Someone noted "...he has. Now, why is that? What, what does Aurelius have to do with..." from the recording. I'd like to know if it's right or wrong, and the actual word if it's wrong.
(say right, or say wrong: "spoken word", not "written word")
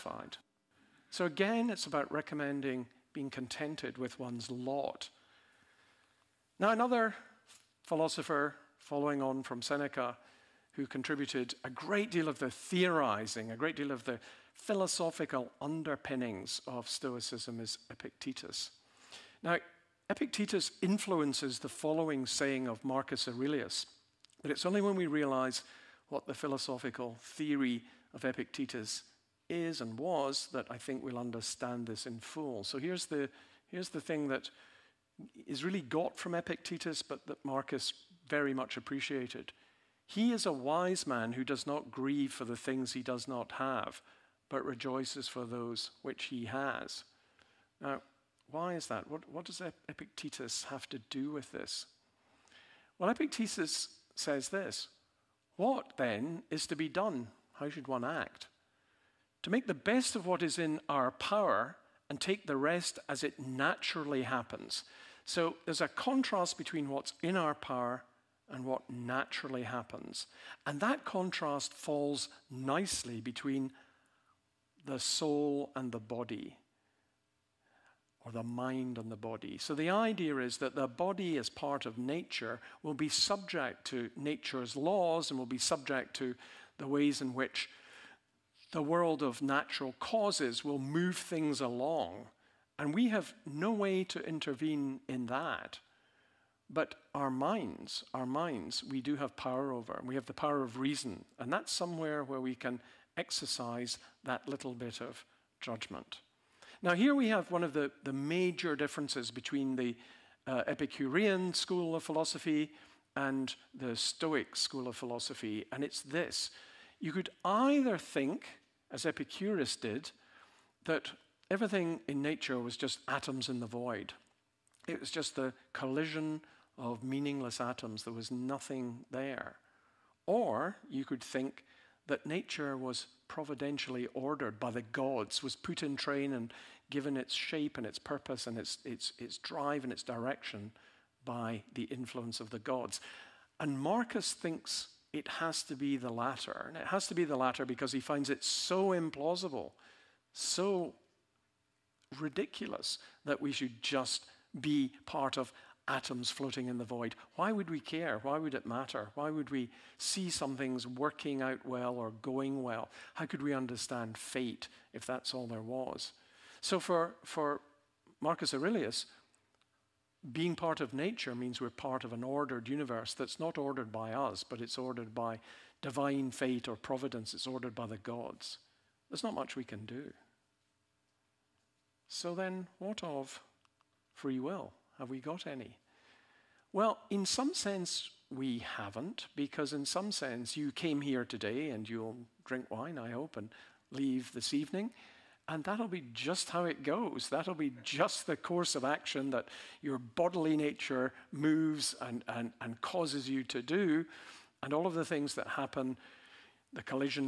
wrong: "Epictetus", not "Aurelius".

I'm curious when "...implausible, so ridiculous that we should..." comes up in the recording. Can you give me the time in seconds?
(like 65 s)
148 s.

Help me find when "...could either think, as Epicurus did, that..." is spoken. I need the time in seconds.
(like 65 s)
117 s.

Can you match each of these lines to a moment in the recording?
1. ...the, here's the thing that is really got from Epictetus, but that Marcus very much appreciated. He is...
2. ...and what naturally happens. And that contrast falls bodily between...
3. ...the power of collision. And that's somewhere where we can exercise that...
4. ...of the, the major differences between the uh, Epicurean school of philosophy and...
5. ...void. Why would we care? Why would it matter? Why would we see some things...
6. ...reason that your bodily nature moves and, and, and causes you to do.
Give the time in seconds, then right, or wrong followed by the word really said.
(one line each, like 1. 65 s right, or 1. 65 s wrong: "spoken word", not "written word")
1. 33 s right
2. 68 s wrong: "nicely", not "bodily"
3. 100 s wrong: "reason", not "collision"
4. 107 s right
5. 156 s right
6. 198 s wrong: "action", not "reason".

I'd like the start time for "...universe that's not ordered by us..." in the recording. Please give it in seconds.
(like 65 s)
172 s.